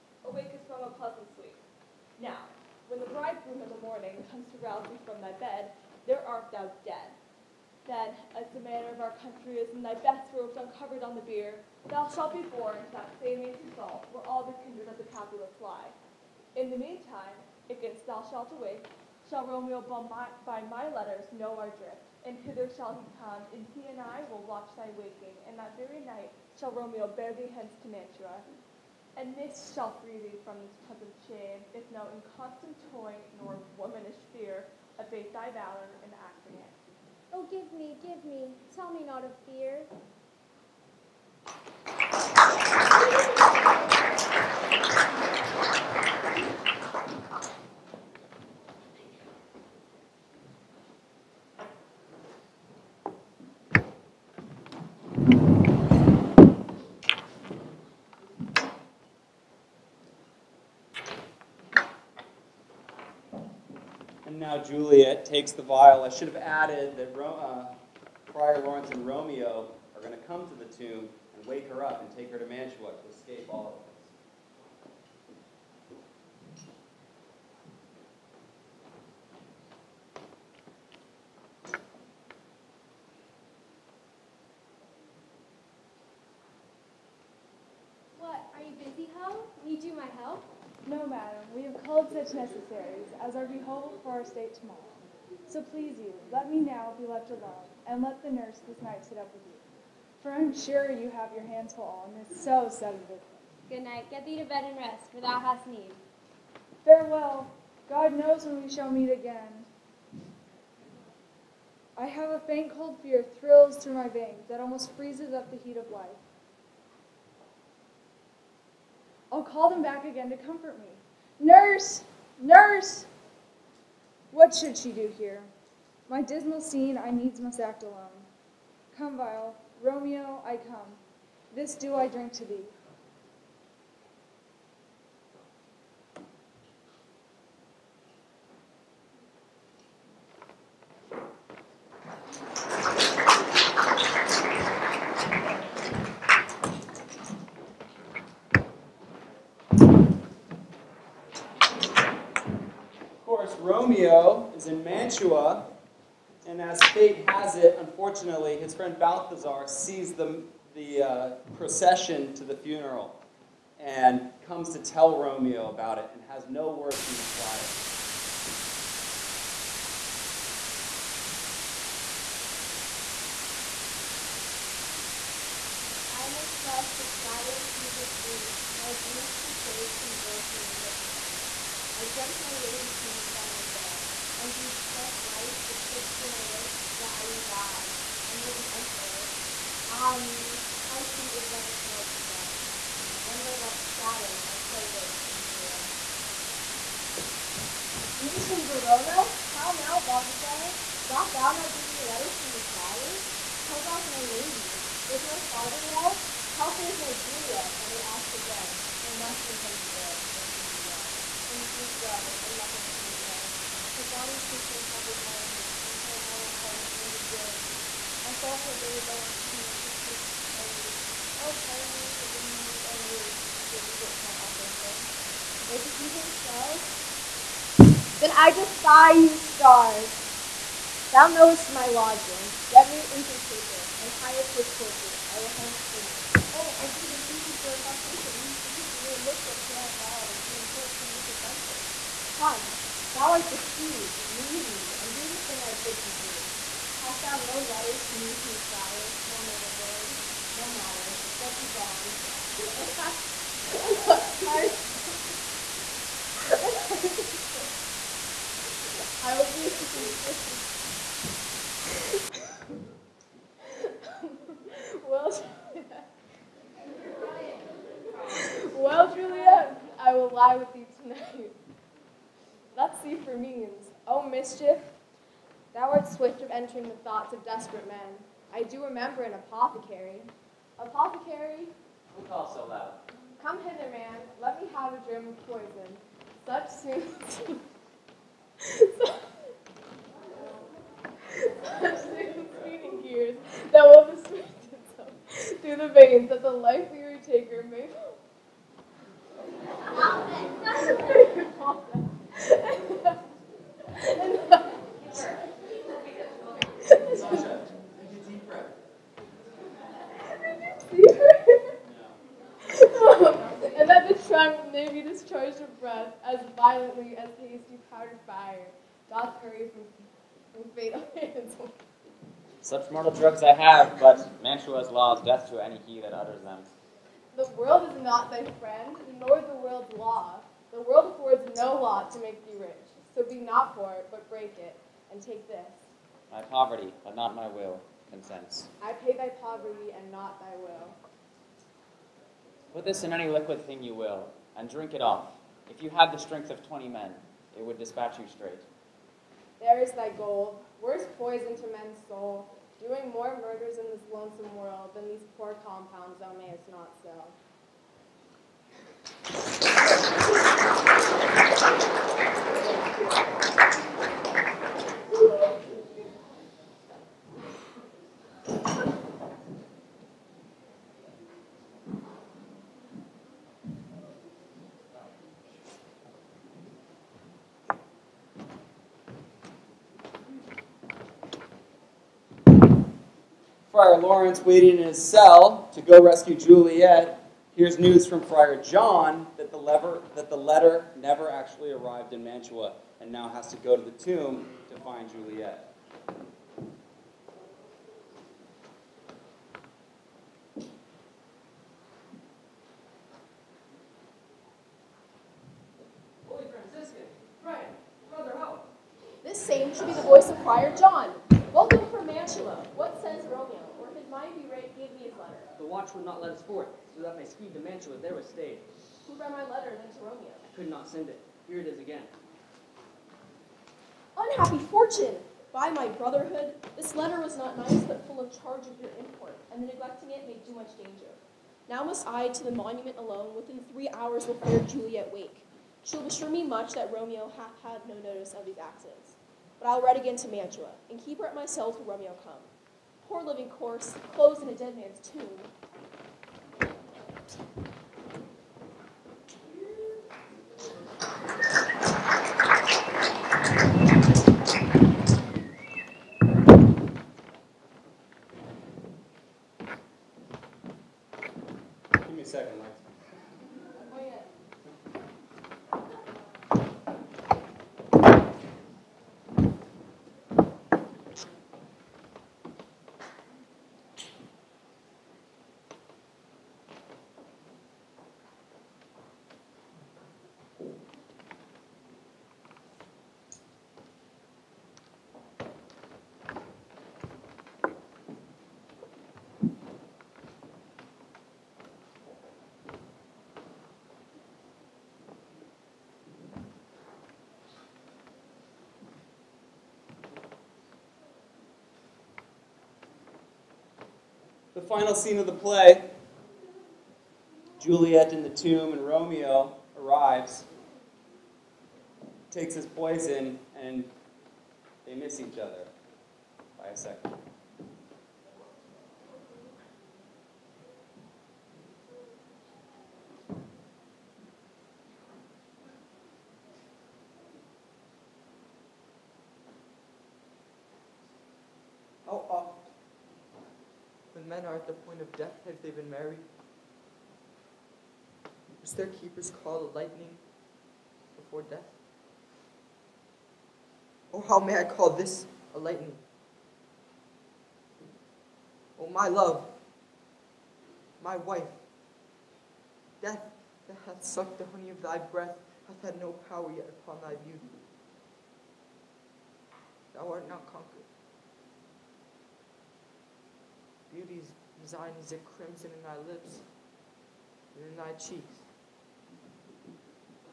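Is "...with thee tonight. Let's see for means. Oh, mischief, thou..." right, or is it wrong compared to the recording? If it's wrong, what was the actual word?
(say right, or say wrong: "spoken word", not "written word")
right.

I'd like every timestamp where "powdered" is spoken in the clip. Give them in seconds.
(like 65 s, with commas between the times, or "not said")
317 s.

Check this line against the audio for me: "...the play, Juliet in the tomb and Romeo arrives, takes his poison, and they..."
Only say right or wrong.
right.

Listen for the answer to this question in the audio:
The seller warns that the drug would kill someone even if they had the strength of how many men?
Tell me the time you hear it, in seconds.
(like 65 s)
346 s.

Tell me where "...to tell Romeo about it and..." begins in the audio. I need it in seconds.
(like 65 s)
164 s.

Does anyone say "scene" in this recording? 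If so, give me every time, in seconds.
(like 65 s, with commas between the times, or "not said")
126 s, 504 s.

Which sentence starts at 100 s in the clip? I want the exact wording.
For I'm sure you have your hands full on this so sudden business.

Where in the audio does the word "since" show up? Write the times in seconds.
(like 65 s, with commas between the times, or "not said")
223 s.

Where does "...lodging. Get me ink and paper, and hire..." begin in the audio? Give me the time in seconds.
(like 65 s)
231 s.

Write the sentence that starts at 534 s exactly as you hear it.
are at the point of death if they have been married?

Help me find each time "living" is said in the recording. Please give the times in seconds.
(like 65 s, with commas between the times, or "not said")
443 s.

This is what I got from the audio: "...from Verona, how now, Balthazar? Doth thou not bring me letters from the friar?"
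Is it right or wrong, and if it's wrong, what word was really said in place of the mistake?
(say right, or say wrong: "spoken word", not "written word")
right.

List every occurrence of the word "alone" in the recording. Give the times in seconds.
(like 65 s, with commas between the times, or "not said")
97 s, 127 s, 432 s.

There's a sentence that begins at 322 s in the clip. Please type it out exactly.
Such mortal drugs I have, but Mantua's law is death to any he that utters them.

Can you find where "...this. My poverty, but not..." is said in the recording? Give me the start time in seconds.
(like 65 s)
335 s.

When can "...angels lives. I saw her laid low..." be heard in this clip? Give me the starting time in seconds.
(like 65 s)
216 s.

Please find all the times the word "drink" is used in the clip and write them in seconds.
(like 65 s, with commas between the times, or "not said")
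132 s, 344 s.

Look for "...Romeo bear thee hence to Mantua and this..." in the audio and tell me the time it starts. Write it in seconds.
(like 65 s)
26 s.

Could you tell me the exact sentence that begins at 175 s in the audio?
If I may trust the flattering truth of sleep, my dreams presage some joyful news at hand.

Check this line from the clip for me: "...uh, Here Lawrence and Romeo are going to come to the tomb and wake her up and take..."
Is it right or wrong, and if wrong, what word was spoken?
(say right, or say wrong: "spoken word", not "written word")
wrong: "Friar", not "Here".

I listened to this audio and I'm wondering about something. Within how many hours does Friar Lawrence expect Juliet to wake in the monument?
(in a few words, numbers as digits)
3.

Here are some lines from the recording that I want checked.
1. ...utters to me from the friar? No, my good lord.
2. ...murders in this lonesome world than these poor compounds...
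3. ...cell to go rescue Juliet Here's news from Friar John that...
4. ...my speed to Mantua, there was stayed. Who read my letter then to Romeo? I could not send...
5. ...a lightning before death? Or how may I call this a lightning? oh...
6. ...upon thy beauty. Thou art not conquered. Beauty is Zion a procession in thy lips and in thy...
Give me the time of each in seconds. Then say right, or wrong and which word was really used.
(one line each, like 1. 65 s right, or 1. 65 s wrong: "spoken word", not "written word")
1. 247 s wrong: "letters", not "utters"
2. 353 s right
3. 385 s right
4. 417 s right
5. 539 s right
6. 556 s wrong: "crimson", not "procession".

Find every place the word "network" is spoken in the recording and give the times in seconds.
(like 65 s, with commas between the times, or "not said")
not said.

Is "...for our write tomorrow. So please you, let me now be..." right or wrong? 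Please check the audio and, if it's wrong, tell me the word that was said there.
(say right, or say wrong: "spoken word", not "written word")
wrong: "state", not "write".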